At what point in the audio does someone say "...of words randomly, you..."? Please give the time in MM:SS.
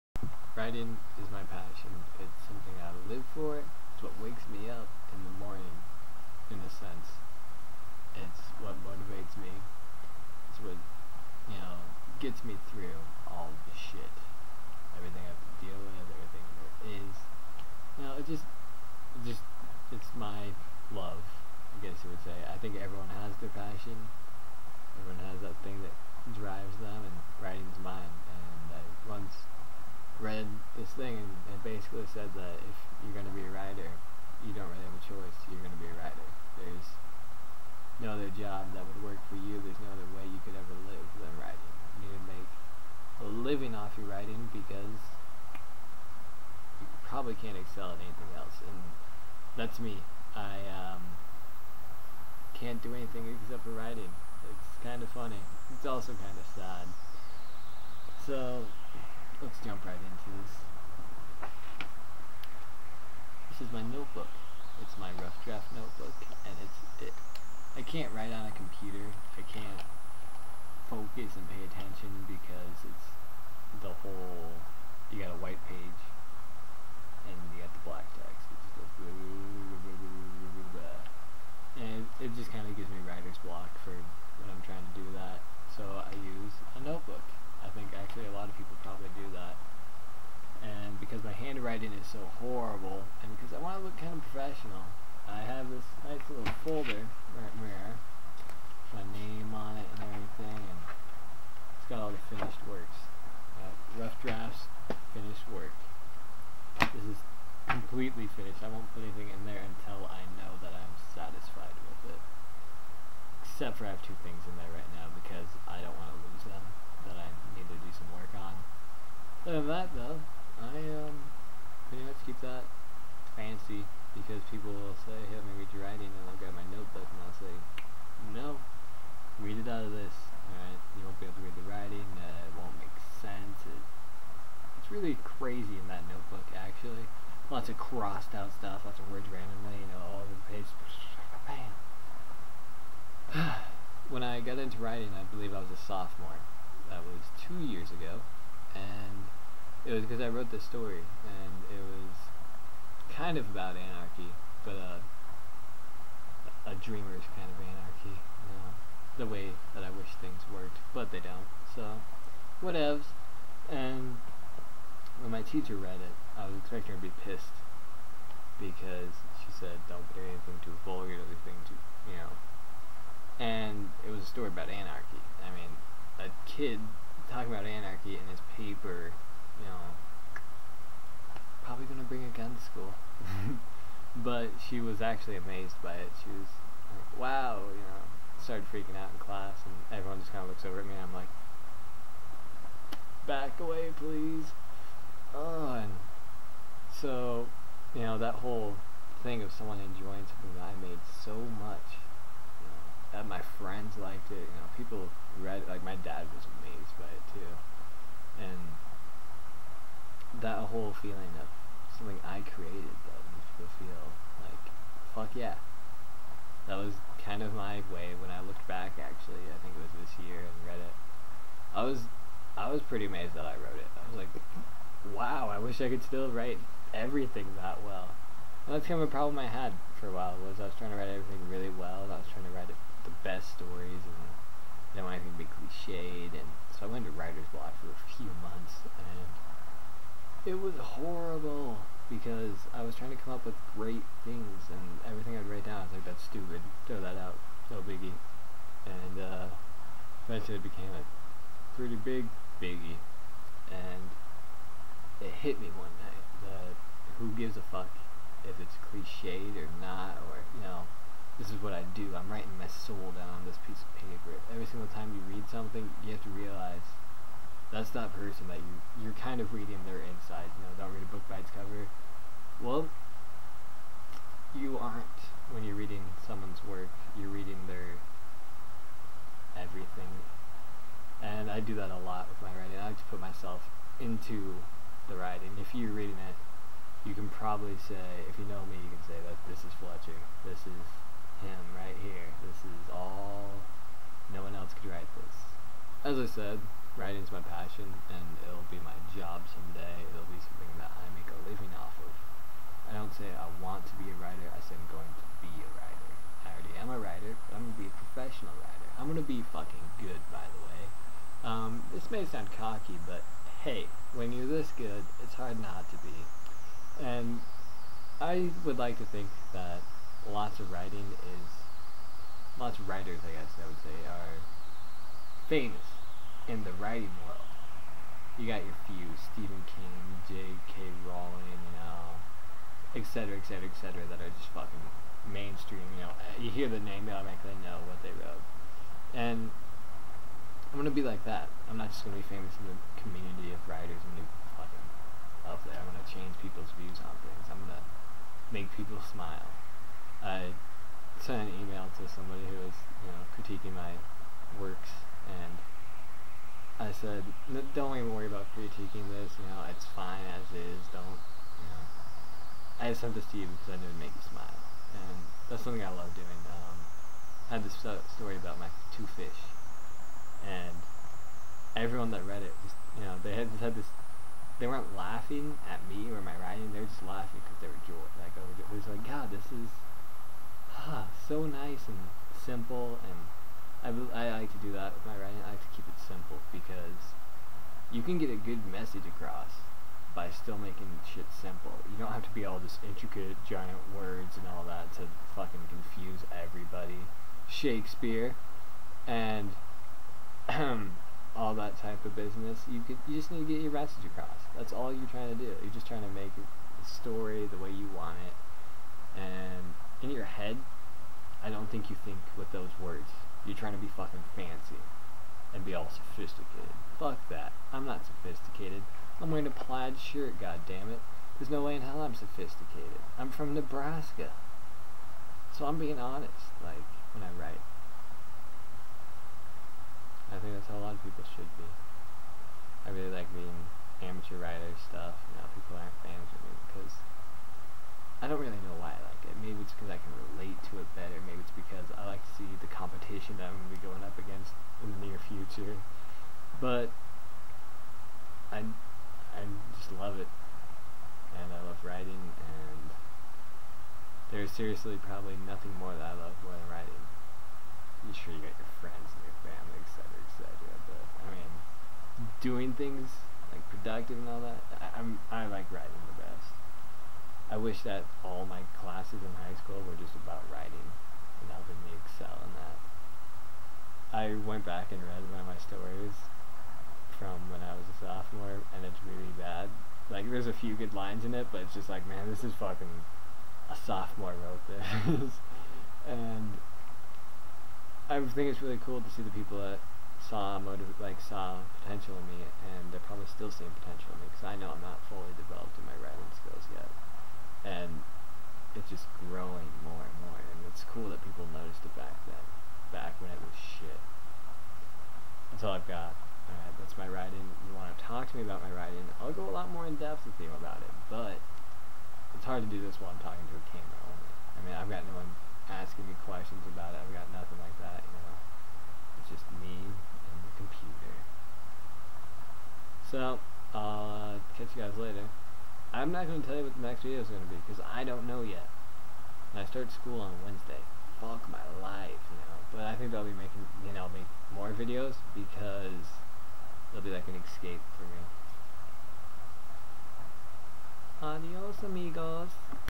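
02:18.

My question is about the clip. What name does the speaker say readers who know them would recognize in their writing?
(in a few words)
Fletcher.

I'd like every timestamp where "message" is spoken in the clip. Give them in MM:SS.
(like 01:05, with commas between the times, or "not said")
06:28, 06:43.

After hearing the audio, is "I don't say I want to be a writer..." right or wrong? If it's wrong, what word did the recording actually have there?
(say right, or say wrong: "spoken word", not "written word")
right.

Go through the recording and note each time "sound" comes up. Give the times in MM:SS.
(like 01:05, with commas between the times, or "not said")
05:12.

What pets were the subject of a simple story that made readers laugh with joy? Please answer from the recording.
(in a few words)
Two fish.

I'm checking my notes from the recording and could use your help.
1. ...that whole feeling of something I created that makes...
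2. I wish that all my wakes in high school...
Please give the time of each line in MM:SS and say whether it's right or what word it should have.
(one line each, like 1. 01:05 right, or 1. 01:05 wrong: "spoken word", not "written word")
1. 03:30 right
2. 07:47 wrong: "classes", not "wakes".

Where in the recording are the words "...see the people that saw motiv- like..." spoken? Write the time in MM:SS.
08:09.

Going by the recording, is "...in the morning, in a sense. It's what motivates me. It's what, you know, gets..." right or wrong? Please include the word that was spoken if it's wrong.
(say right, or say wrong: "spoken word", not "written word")
right.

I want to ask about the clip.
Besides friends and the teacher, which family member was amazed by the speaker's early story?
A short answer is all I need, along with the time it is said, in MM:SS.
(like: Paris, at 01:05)
Dad, at 03:25.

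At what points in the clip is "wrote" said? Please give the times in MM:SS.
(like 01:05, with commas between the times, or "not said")
02:30, 03:43, 05:38, 08:04.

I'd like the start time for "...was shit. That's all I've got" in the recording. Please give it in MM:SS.
08:23.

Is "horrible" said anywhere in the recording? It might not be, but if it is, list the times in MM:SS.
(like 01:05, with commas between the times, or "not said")
01:32, 04:00.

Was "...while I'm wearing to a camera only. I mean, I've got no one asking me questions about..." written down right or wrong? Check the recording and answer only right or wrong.
wrong.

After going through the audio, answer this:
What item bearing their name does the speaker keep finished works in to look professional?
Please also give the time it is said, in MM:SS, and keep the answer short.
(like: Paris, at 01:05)
Folder, at 01:36.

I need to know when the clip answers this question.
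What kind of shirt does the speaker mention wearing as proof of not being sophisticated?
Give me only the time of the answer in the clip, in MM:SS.
06:59.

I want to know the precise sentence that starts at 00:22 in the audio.
I think everyone has their passion.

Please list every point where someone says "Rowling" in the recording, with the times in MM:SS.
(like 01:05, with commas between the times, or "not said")
05:31.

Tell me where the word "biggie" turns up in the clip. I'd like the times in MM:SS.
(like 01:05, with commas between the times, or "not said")
04:07, 04:12.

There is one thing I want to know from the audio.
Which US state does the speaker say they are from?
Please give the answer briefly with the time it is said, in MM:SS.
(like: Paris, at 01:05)
Nebraska, at 07:03.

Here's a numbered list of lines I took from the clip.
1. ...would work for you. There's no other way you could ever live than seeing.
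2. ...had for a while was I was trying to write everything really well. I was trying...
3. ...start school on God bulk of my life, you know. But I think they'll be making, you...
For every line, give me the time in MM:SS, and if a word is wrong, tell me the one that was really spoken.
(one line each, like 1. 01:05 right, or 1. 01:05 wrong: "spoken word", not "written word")
1. 00:38 wrong: "writing", not "seeing"
2. 03:49 right
3. 08:49 wrong: "Wednesday", not "God".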